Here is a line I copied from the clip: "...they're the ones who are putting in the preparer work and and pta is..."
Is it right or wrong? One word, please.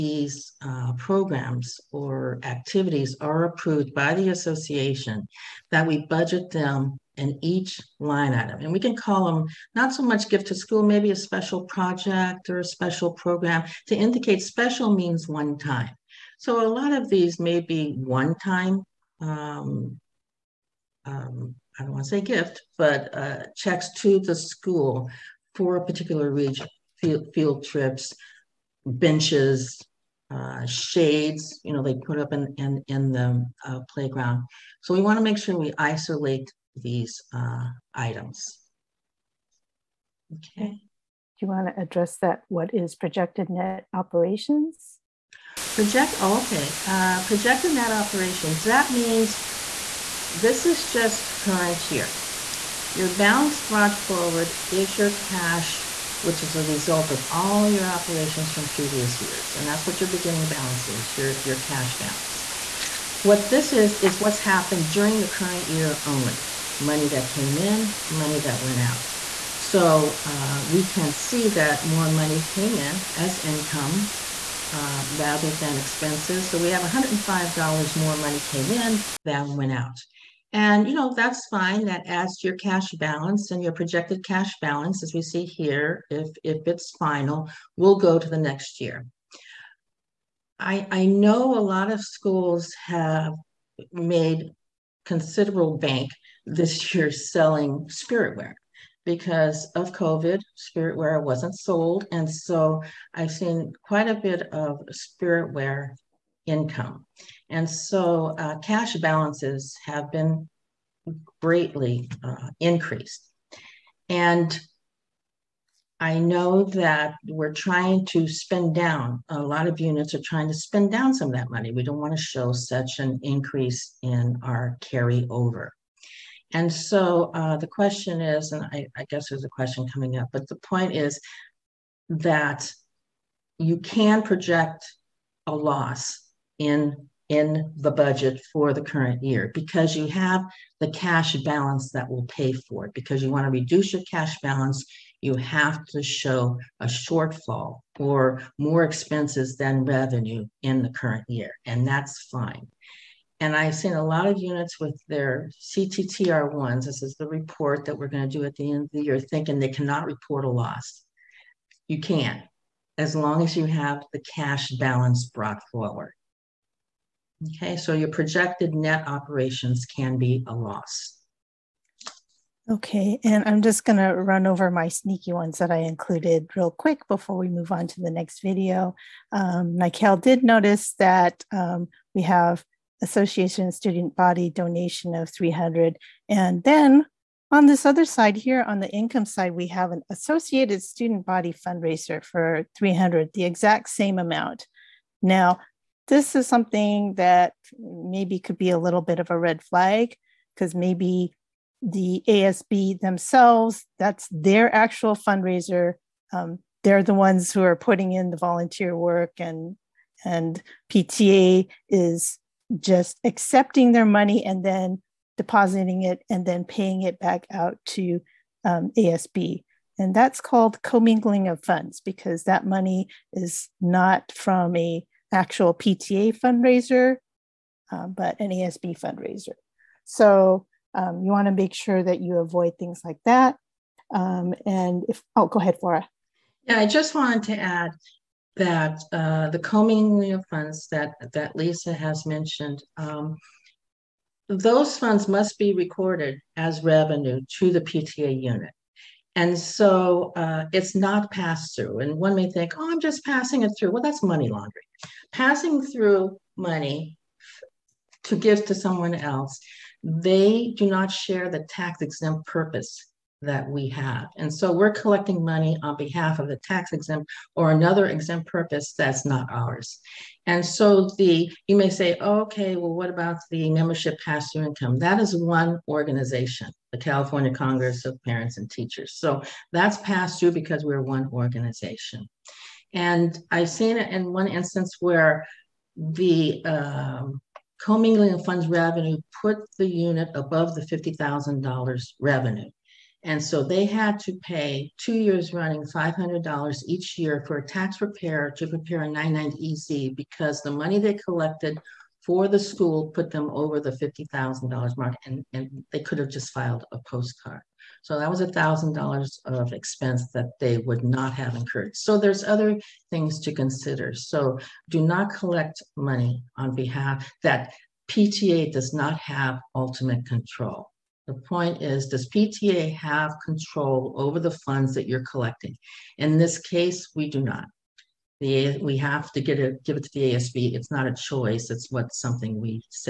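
wrong.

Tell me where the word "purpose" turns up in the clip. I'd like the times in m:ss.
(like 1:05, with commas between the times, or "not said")
4:22, 4:28.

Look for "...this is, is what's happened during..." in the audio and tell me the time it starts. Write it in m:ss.
1:03.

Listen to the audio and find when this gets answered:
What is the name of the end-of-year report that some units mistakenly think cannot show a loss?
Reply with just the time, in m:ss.
2:35.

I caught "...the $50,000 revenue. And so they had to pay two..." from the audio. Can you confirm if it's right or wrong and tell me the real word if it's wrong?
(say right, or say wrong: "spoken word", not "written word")
right.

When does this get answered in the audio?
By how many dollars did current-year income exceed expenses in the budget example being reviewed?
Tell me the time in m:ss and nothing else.
1:16.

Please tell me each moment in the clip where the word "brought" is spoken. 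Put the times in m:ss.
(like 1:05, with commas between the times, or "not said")
0:53, 2:45.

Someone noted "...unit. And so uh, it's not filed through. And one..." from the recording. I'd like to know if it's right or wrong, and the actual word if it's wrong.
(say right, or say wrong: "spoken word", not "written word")
wrong: "passed", not "filed".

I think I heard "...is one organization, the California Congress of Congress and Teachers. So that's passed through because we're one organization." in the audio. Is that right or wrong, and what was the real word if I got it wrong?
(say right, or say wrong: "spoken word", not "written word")
wrong: "Parents", not "Congress".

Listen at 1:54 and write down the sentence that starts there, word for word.
And I know that we're trying to spend down, a lot of units are trying to spend down some of that money.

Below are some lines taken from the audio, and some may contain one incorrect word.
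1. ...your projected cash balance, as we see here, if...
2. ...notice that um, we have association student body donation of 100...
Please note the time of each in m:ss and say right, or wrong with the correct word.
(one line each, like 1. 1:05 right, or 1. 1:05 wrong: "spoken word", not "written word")
1. 1:23 right
2. 3:00 wrong: "300", not "100".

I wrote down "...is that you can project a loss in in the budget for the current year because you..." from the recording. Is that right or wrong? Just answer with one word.
right.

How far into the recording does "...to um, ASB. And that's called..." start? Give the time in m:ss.
3:37.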